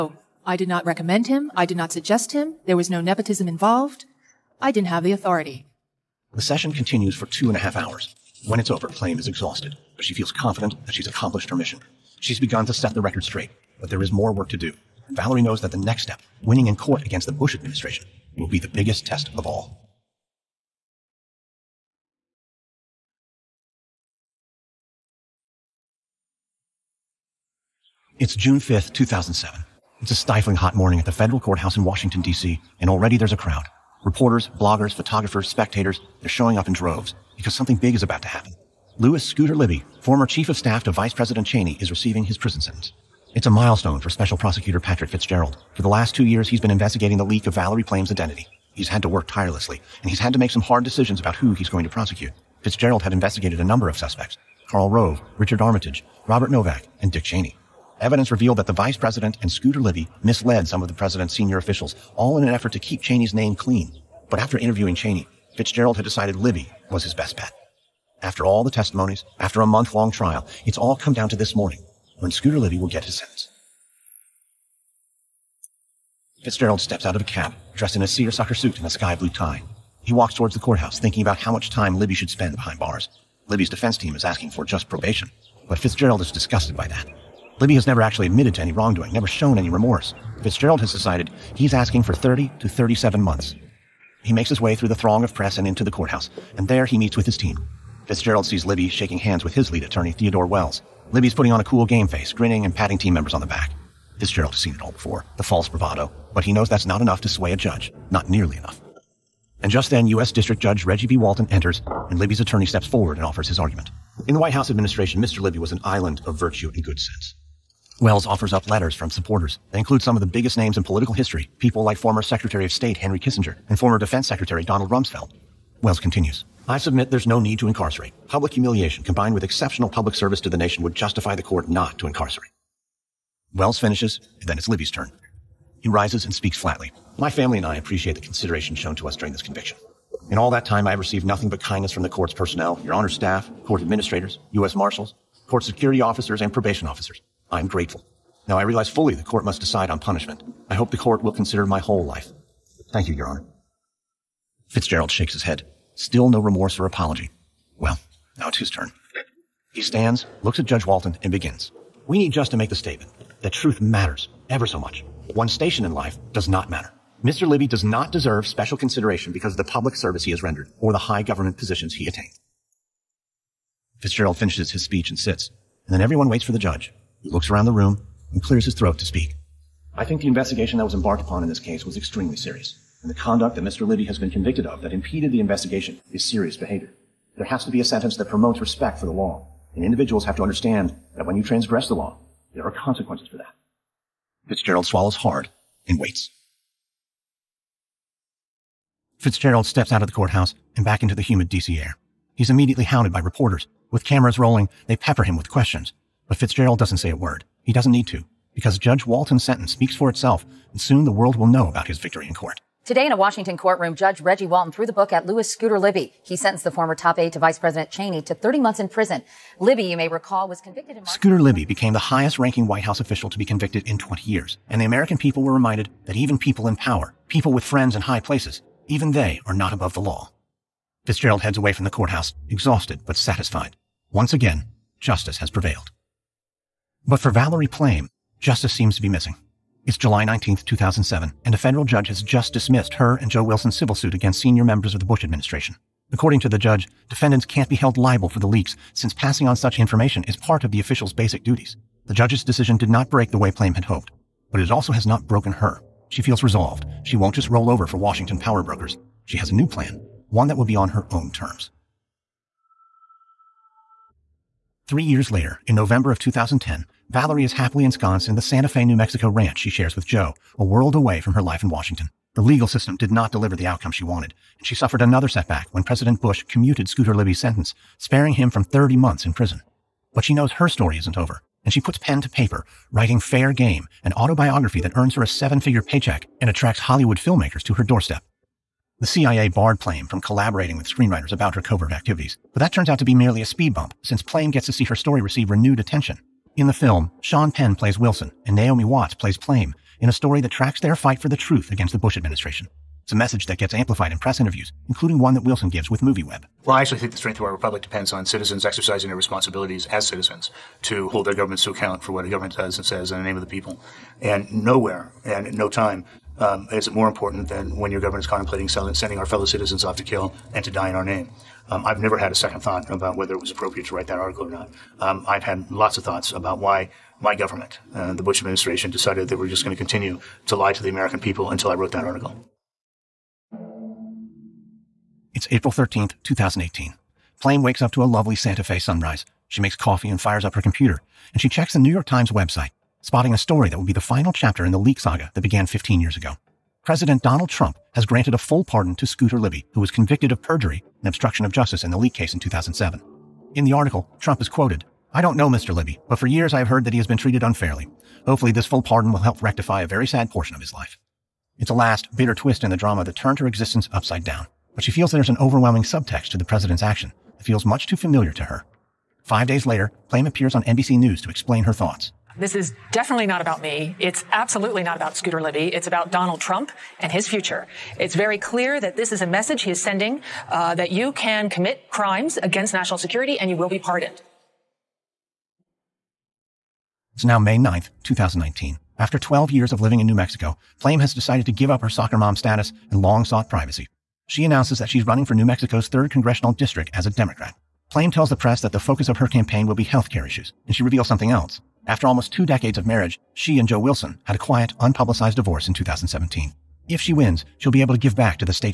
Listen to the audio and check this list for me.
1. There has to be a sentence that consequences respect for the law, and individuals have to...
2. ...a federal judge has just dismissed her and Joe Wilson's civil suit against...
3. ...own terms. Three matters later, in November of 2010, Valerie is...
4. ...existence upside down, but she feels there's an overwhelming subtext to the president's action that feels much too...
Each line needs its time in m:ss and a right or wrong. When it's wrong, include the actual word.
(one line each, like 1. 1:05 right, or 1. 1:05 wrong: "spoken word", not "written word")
1. 3:07 wrong: "promotes", not "consequences"
2. 4:01 right
3. 4:21 wrong: "years", not "matters"
4. 6:03 right.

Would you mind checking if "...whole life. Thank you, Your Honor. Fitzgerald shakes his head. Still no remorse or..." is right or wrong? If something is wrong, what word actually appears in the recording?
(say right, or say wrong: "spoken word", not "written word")
right.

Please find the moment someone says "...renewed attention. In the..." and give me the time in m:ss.
4:55.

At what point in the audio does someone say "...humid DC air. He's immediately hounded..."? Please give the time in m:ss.
3:21.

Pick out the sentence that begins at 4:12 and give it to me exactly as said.
The judge's decision did not break the way Plame had hoped, but it also has not broken her.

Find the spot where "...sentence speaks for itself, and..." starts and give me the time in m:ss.
3:29.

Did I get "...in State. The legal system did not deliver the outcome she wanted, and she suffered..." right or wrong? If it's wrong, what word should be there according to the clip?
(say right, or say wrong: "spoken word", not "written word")
wrong: "Washington", not "State".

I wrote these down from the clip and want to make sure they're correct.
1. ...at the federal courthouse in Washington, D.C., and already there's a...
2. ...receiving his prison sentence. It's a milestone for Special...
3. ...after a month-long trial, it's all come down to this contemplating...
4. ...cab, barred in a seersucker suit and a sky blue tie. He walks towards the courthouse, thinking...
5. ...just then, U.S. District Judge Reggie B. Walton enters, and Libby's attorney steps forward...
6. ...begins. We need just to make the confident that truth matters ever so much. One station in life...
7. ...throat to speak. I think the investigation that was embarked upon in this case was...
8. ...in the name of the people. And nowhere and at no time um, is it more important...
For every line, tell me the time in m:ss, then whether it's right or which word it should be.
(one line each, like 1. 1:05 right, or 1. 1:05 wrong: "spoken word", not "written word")
1. 0:31 right
2. 0:41 right
3. 1:09 wrong: "morning", not "contemplating"
4. 1:17 wrong: "dressed", not "barred"
5. 1:49 right
6. 2:41 wrong: "statement", not "confident"
7. 2:58 right
8. 5:13 right.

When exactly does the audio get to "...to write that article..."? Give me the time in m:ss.
5:23.